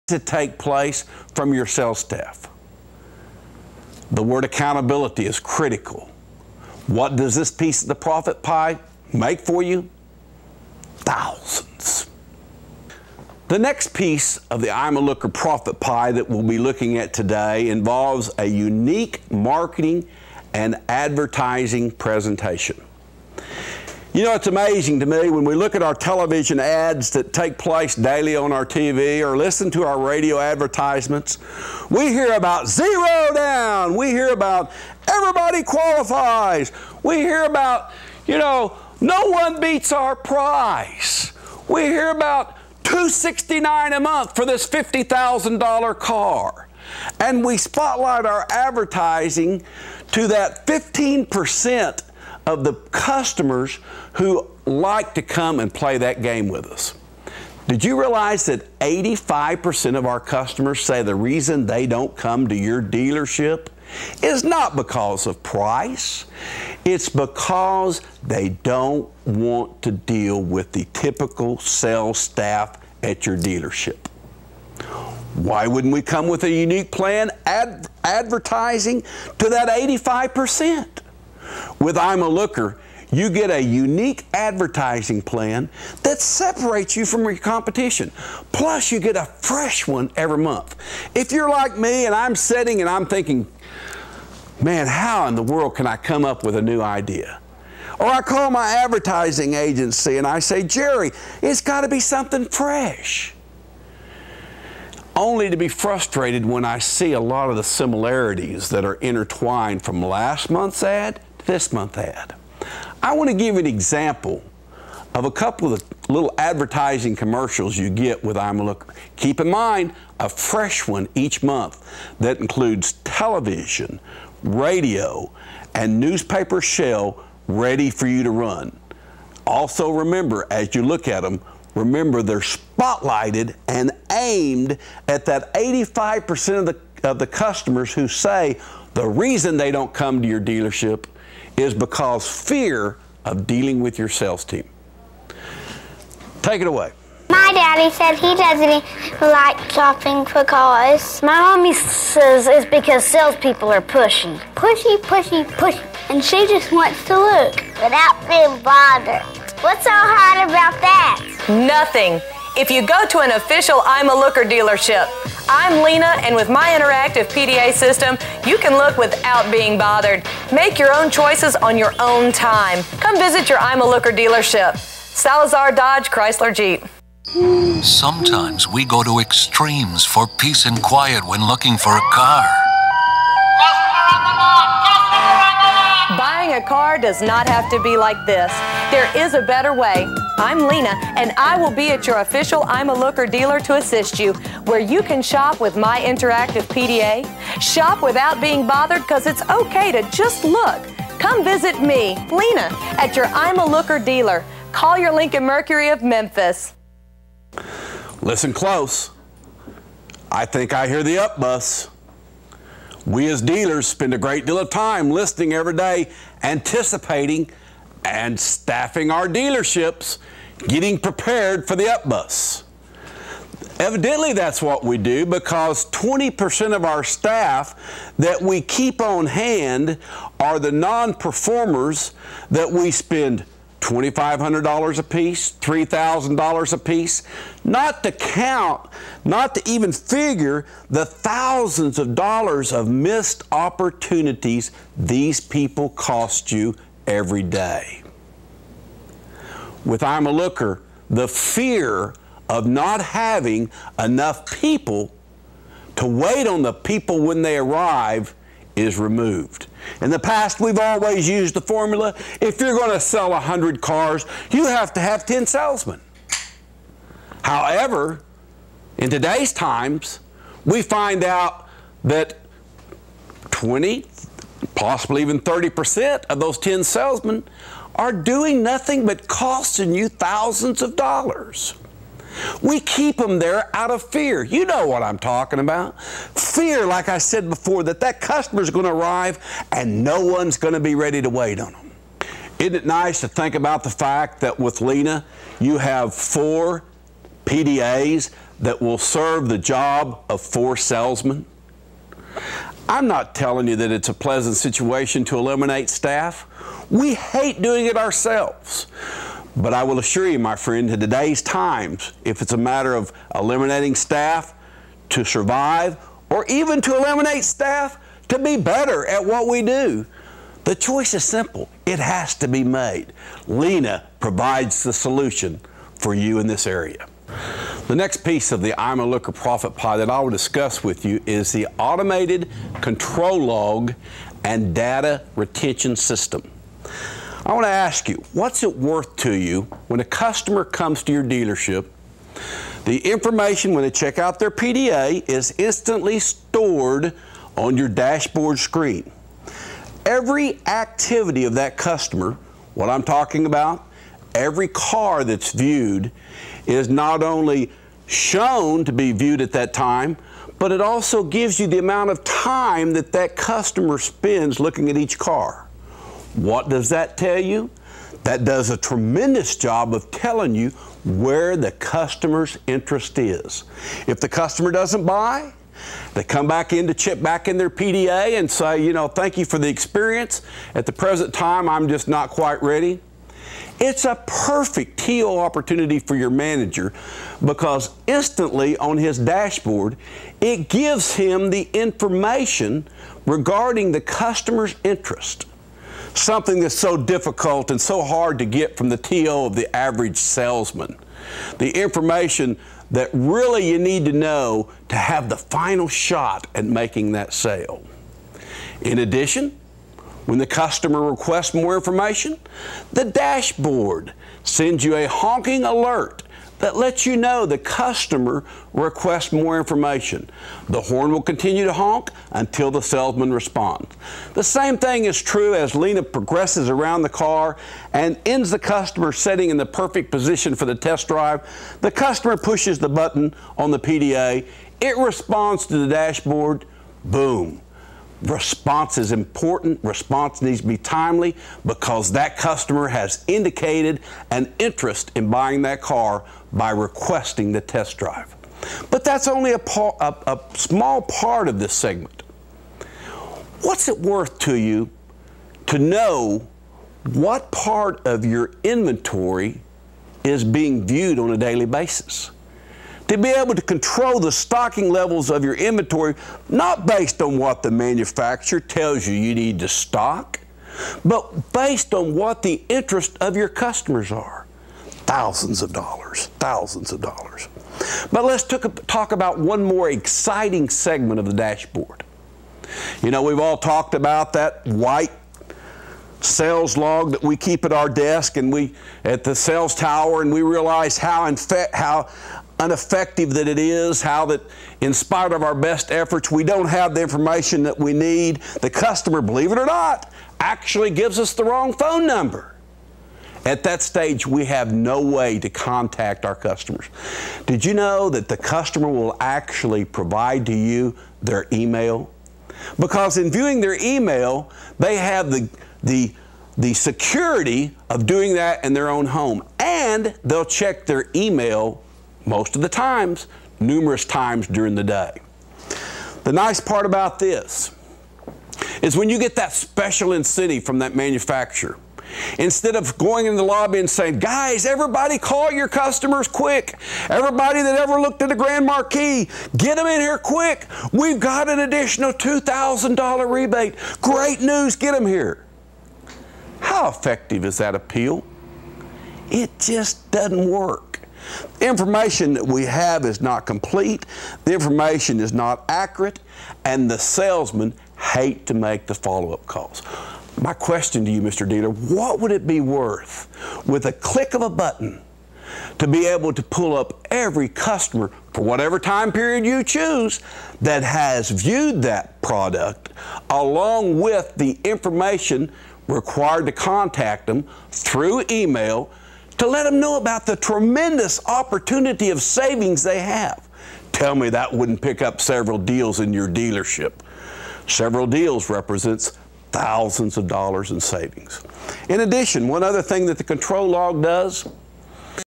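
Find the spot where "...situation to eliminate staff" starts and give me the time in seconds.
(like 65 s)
304 s.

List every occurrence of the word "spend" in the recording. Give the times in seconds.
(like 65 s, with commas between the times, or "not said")
213 s, 232 s, 363 s.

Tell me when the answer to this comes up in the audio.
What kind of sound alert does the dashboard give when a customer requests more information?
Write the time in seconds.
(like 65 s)
415 s.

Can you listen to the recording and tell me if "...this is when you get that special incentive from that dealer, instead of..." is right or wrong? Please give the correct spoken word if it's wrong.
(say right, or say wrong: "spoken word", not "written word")
wrong: "manufacturer", not "dealer".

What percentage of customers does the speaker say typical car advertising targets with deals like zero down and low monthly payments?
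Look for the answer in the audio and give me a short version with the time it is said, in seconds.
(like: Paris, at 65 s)
15%, at 50 s.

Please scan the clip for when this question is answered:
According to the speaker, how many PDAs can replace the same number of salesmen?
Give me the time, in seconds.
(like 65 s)
296 s.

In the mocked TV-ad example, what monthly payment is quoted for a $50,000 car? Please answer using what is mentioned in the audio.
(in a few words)
269.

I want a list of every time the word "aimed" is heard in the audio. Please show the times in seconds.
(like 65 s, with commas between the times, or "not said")
134 s.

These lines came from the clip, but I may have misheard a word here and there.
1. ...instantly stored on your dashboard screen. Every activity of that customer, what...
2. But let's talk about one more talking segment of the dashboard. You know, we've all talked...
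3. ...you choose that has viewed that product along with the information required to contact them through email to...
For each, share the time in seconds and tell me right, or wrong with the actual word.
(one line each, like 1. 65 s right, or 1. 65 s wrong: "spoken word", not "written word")
1. 345 s right
2. 478 s wrong: "exciting", not "talking"
3. 569 s right.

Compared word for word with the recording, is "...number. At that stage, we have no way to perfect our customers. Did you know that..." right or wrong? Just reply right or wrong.
wrong.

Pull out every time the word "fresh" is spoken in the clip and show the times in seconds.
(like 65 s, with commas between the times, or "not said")
89 s, 102 s, 120 s.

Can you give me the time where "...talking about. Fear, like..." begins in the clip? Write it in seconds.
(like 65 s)
285 s.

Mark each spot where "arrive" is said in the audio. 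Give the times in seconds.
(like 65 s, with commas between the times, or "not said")
257 s, 288 s.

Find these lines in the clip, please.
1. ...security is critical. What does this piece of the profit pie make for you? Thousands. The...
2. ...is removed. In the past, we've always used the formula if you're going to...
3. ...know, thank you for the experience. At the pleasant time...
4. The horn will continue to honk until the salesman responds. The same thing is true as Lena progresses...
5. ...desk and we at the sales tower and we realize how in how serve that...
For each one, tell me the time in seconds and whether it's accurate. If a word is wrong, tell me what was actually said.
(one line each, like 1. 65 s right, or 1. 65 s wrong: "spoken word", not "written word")
1. 4 s wrong: "accountability", not "security"
2. 258 s right
3. 378 s wrong: "present", not "pleasant"
4. 420 s right
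5. 487 s wrong: "ineffective", not "serve".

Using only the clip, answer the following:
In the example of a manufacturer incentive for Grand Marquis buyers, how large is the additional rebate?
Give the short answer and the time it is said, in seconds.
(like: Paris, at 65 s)
$2,000, at 542 s.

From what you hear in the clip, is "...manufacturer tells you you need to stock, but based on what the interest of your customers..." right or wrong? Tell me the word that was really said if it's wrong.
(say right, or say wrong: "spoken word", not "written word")
right.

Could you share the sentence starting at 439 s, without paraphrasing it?
Response needs to be timely because that customer has indicated an interest in buying that car by requesting the test drive.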